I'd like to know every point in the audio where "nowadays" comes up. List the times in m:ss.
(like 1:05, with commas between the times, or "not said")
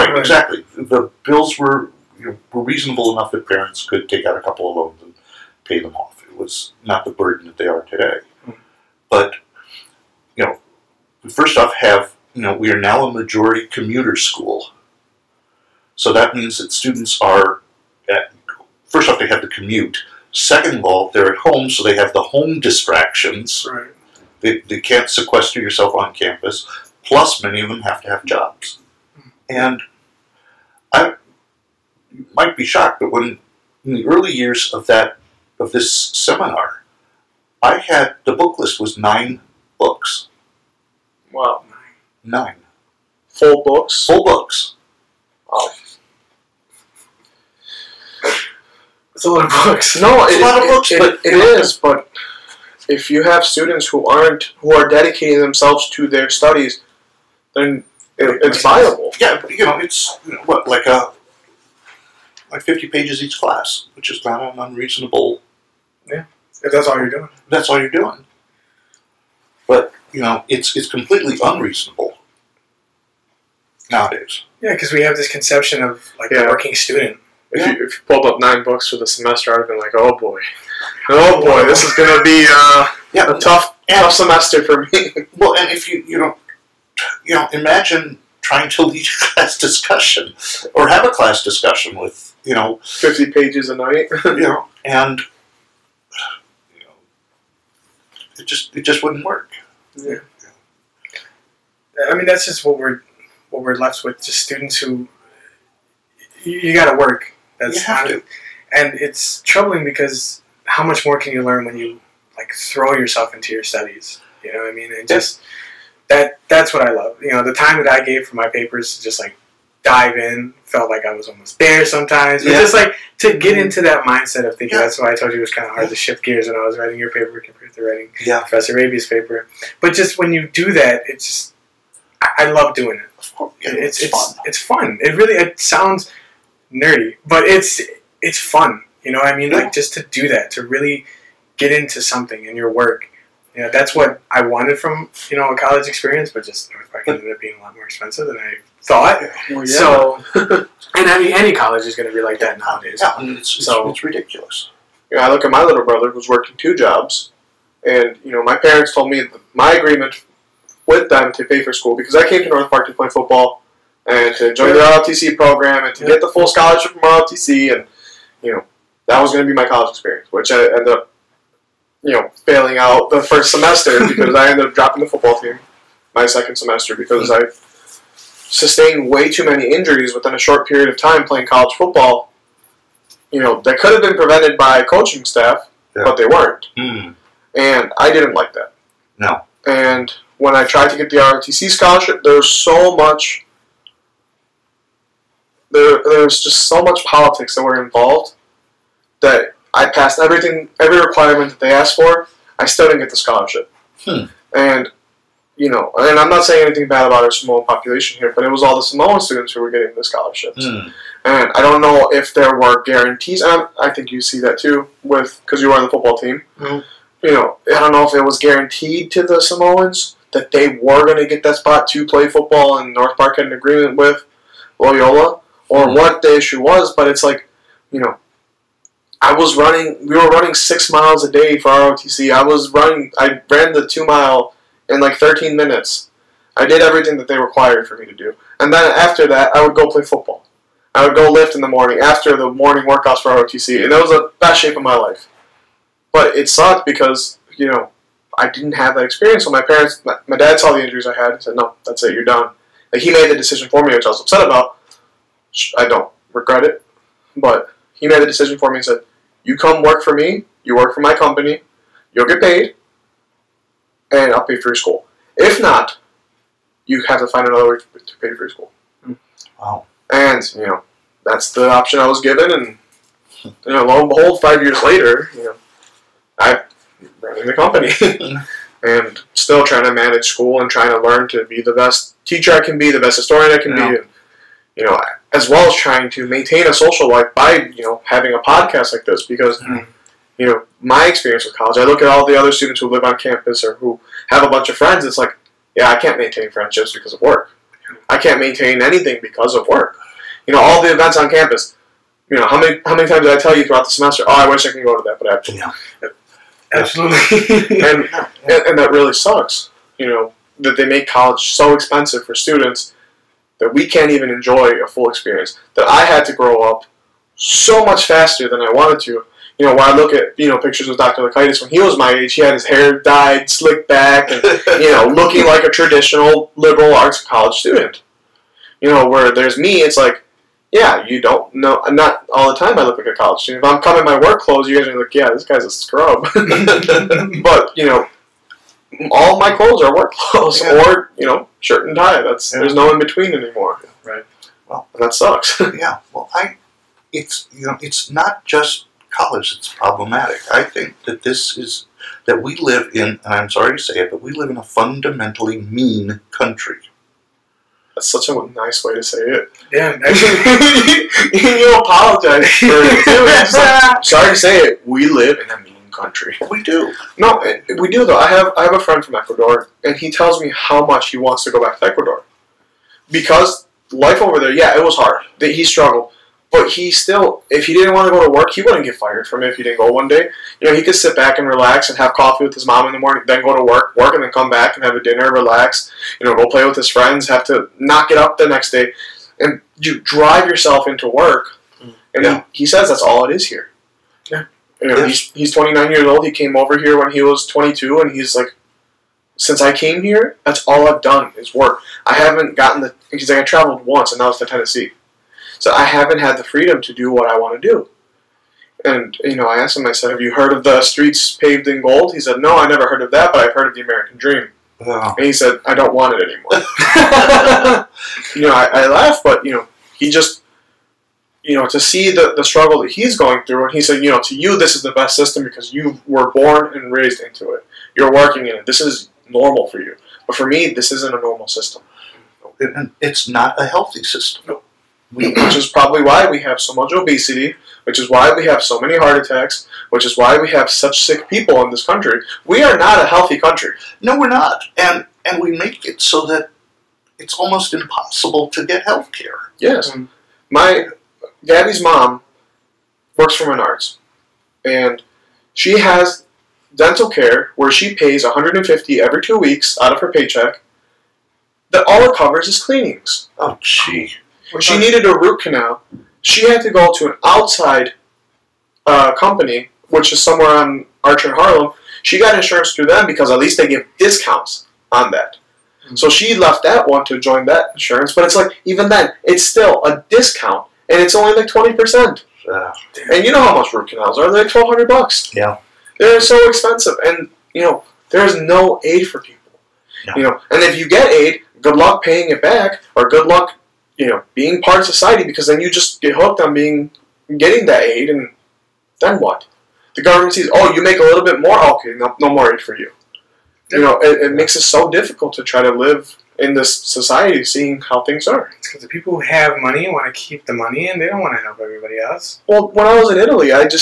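1:13, 2:32.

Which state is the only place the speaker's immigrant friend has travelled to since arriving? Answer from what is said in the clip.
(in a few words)
Tennessee.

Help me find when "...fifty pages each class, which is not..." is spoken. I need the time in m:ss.
1:02.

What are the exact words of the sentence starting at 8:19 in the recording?
The government sees, oh, you make a little bit more, okay, no, no more aid for you.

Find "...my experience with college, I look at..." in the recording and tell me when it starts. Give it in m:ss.
4:50.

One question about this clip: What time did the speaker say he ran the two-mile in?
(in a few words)
13 minutes.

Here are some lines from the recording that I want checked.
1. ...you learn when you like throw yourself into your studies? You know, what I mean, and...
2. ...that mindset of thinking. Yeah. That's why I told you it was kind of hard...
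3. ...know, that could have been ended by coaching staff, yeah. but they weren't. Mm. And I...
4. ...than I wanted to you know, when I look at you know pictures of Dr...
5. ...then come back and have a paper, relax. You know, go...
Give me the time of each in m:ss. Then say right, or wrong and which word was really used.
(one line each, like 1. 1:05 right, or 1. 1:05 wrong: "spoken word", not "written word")
1. 1:51 right
2. 2:03 right
3. 3:03 wrong: "prevented", not "ended"
4. 5:18 right
5. 6:24 wrong: "dinner", not "paper".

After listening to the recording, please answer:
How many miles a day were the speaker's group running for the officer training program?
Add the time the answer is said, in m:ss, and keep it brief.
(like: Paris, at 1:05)
6, at 3:50.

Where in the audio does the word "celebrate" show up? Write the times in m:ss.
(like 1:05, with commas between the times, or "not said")
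not said.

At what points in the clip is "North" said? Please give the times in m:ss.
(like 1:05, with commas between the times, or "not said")
2:26, 2:42, 3:42.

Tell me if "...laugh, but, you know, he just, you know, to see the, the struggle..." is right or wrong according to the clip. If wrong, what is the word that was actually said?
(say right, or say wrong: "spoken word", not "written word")
right.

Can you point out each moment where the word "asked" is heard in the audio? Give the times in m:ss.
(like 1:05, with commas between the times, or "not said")
3:21, 6:49.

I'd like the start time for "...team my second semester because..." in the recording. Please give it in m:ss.
2:55.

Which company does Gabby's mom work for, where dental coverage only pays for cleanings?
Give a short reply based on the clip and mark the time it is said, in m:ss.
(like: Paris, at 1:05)
Menards, at 7:33.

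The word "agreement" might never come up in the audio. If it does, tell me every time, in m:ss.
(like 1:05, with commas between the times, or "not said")
2:39, 3:43.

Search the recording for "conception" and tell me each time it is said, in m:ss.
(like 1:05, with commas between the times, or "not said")
1:15.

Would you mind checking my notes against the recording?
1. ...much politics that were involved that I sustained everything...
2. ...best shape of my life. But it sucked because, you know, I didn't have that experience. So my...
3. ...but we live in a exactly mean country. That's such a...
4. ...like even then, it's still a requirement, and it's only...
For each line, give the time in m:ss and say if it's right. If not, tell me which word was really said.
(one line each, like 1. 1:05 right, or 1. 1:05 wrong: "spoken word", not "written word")
1. 3:16 wrong: "passed", not "sustained"
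2. 4:04 right
3. 5:54 wrong: "fundamentally", not "exactly"
4. 7:58 wrong: "discount", not "requirement".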